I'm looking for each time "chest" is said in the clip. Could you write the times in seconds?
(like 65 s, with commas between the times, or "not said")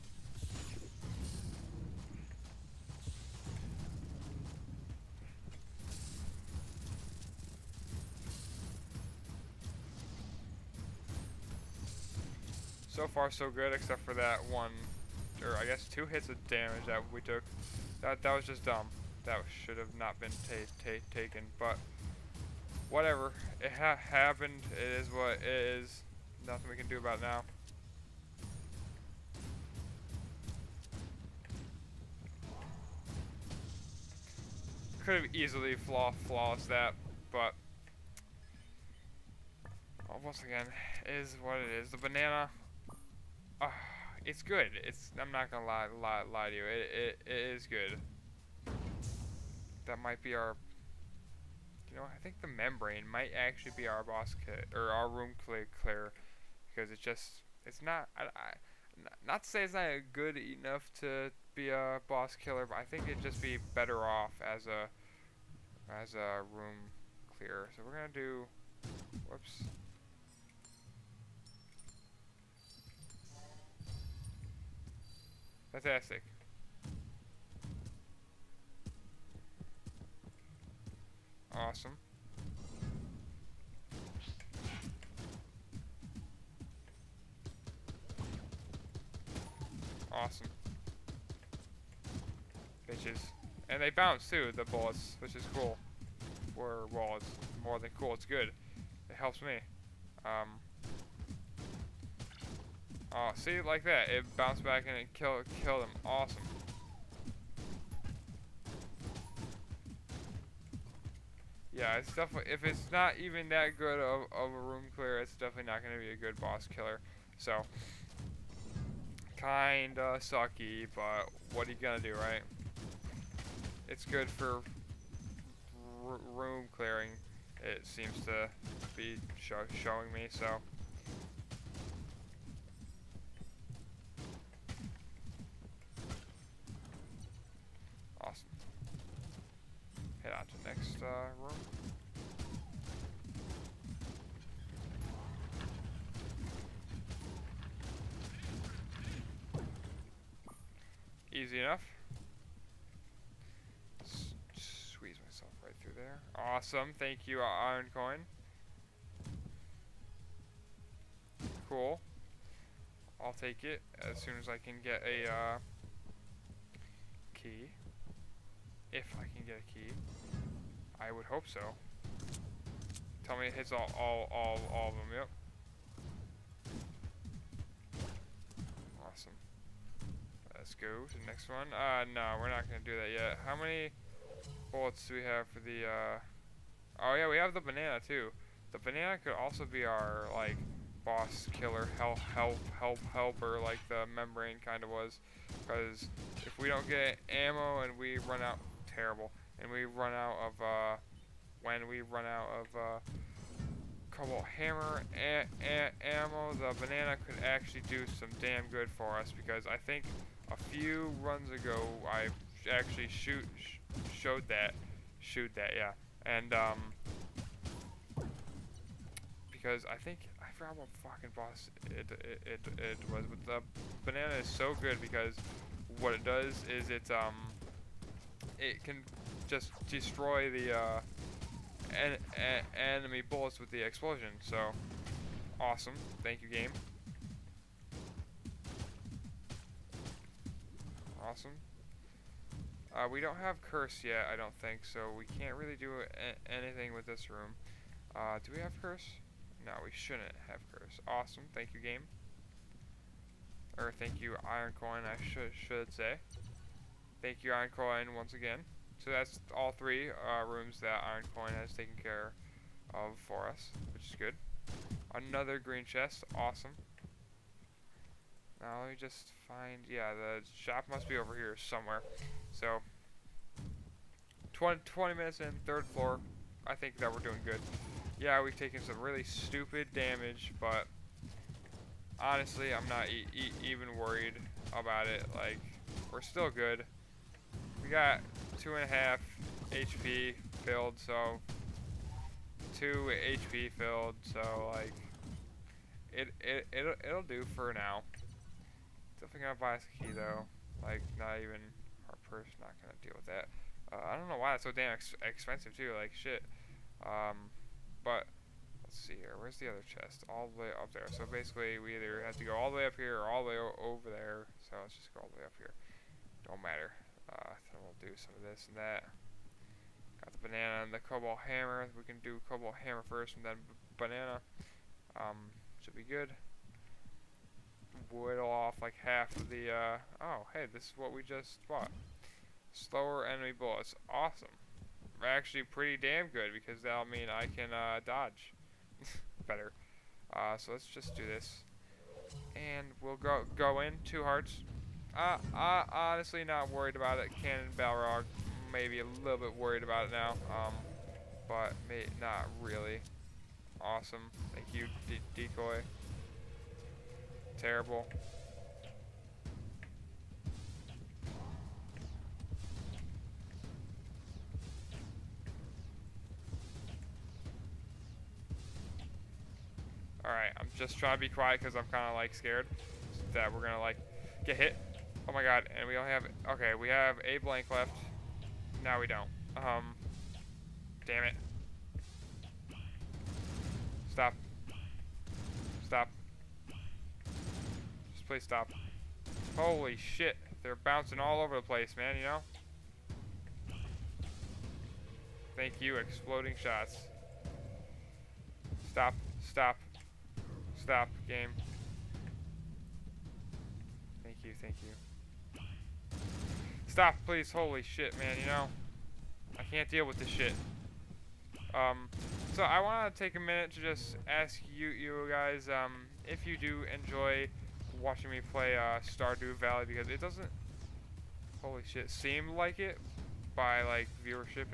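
265 s, 309 s.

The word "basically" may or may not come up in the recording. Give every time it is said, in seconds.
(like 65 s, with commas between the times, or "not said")
311 s.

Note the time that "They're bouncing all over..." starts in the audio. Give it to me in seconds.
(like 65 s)
390 s.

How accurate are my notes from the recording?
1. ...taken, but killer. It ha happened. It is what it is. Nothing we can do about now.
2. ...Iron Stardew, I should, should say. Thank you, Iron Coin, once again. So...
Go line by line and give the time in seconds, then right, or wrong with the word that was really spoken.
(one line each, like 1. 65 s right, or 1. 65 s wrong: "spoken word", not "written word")
1. 21 s wrong: "whatever", not "killer"
2. 254 s wrong: "Coin", not "Stardew".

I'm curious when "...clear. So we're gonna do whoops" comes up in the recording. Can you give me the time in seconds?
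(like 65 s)
67 s.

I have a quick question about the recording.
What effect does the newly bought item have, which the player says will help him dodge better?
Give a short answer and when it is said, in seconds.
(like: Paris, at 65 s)
slower enemy bullets, at 332 s.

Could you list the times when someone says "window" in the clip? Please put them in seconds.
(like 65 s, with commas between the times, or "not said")
not said.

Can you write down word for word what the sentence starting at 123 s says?
it's good for room clearing, it seems to be showing me, so.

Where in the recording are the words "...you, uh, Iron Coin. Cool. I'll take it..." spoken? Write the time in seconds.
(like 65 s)
157 s.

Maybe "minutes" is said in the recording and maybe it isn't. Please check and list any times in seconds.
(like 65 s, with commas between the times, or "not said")
275 s, 413 s.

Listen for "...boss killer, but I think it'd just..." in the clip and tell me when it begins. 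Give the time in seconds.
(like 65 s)
62 s.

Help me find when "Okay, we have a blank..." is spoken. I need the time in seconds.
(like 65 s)
376 s.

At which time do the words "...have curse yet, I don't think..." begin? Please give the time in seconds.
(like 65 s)
243 s.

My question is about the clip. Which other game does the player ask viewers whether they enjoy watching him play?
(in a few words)
Stardew Valley.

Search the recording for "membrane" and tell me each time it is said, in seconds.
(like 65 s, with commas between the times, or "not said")
52 s, 194 s.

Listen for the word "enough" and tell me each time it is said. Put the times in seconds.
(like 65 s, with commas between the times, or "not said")
60 s, 151 s.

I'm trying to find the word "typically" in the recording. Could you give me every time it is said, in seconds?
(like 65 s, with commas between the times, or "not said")
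not said.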